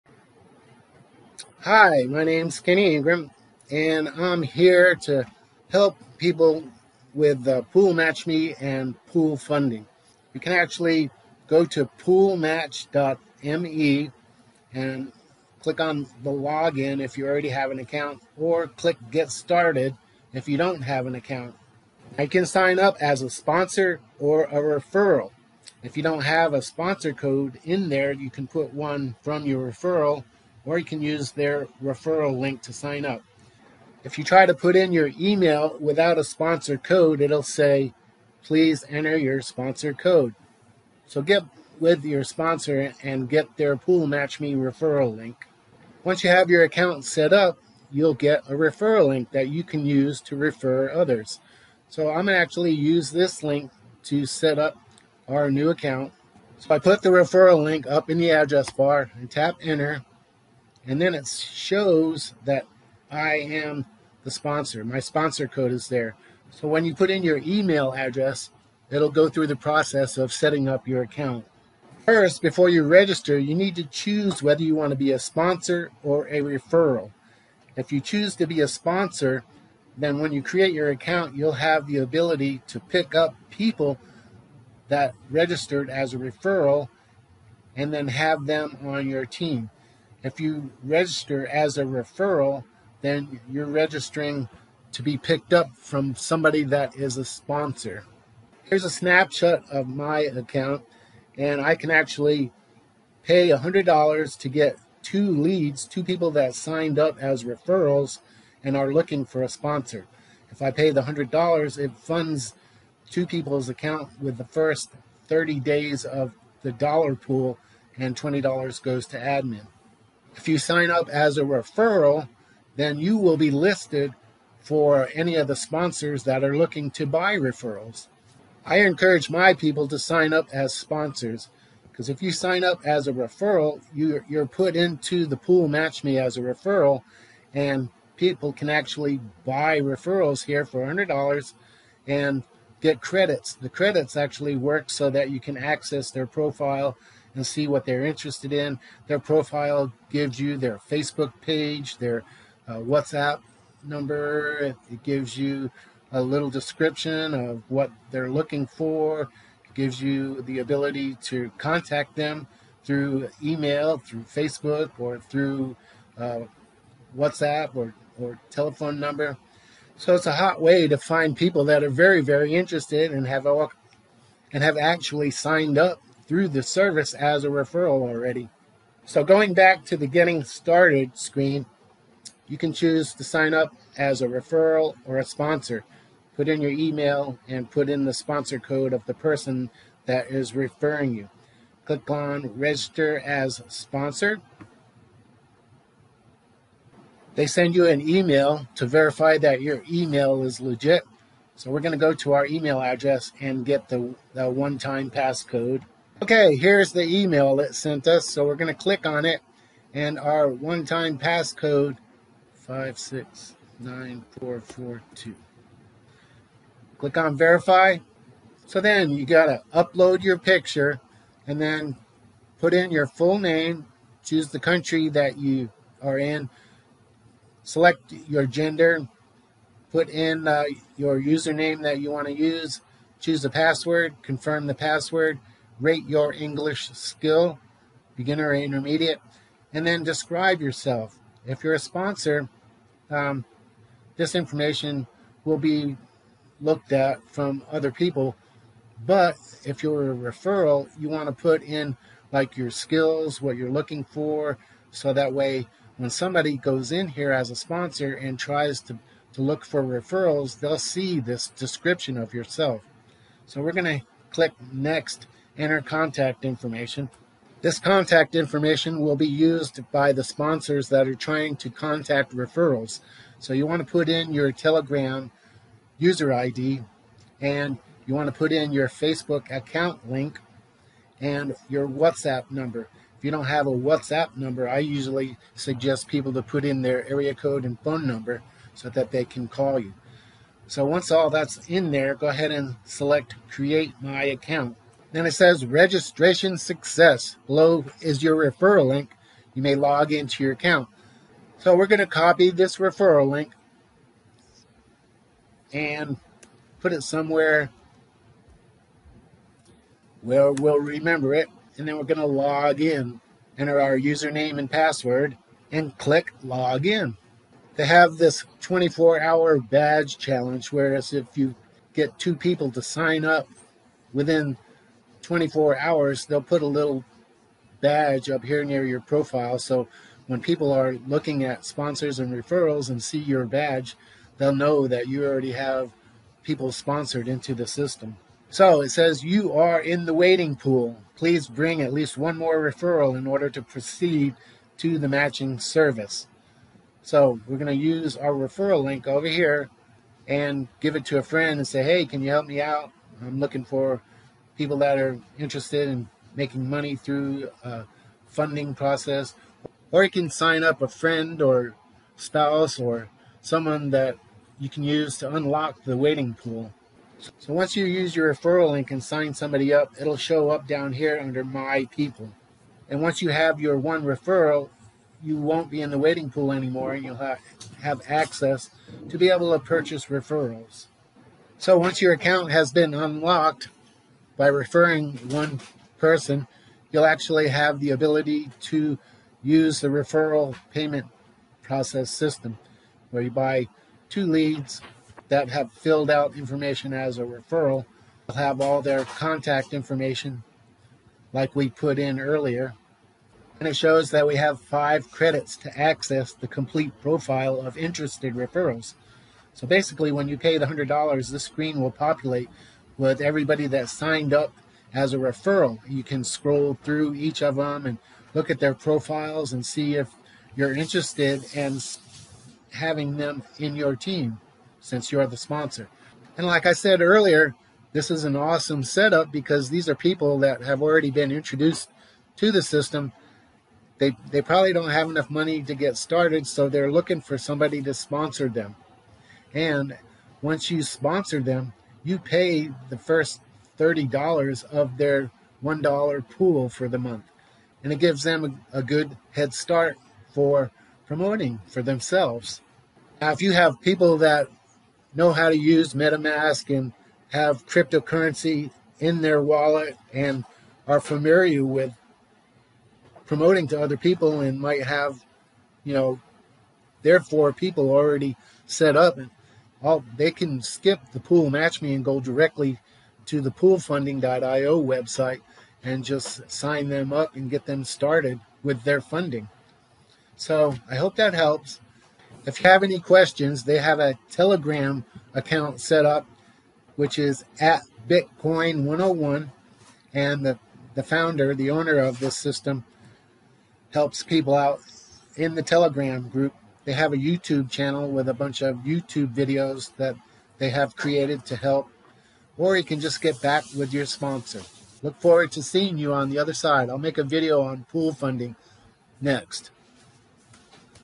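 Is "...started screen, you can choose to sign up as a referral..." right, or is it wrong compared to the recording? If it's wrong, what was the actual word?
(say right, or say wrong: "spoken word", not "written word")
right.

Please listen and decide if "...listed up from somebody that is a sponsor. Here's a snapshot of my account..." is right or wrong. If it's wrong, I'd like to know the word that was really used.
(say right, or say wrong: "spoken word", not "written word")
wrong: "picked", not "listed".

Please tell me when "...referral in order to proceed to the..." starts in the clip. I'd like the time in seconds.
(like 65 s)
342 s.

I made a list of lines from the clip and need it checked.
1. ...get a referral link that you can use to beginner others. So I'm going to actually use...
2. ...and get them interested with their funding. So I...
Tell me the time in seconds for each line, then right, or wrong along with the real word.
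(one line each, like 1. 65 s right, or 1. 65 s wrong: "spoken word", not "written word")
1. 48 s wrong: "refer", not "beginner"
2. 477 s wrong: "started", not "interested".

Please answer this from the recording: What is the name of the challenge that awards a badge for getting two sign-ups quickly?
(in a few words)
24 hour badge challenge.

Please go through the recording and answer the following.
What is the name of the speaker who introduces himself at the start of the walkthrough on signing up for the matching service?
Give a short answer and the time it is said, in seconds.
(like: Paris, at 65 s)
Kenny Ingram, at 2 s.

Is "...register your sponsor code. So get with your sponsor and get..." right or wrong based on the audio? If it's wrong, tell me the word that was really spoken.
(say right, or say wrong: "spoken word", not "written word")
wrong: "enter", not "register".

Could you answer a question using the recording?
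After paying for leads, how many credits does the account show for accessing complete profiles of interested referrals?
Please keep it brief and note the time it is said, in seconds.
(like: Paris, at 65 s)
5, at 404 s.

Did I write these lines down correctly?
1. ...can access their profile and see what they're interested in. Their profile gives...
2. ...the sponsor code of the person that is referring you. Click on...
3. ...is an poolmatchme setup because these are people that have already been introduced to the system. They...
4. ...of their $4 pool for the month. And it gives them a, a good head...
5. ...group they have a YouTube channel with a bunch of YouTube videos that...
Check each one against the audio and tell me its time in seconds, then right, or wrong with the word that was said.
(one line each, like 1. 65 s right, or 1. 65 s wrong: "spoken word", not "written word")
1. 145 s right
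2. 188 s right
3. 428 s wrong: "awesome", not "poolmatchme"
4. 444 s wrong: "1", not "4"
5. 496 s right.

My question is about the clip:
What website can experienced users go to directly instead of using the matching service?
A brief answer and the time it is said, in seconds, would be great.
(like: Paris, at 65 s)
poolfunding.io, at 473 s.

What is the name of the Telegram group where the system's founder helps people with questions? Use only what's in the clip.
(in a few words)
Bitcoin 101.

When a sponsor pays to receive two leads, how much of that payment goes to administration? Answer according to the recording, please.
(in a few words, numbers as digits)
$20.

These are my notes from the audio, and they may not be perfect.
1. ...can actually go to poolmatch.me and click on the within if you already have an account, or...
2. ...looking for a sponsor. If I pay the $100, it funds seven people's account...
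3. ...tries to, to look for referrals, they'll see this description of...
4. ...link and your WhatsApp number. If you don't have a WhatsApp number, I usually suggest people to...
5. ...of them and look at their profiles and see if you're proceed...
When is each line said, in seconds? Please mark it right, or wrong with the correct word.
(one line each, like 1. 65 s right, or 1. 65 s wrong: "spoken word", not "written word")
1. 10 s wrong: "login", not "within"
2. 108 s wrong: "two", not "seven"
3. 258 s right
4. 280 s right
5. 417 s wrong: "interested", not "proceed".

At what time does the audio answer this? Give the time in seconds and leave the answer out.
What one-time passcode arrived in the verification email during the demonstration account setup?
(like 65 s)
212 s.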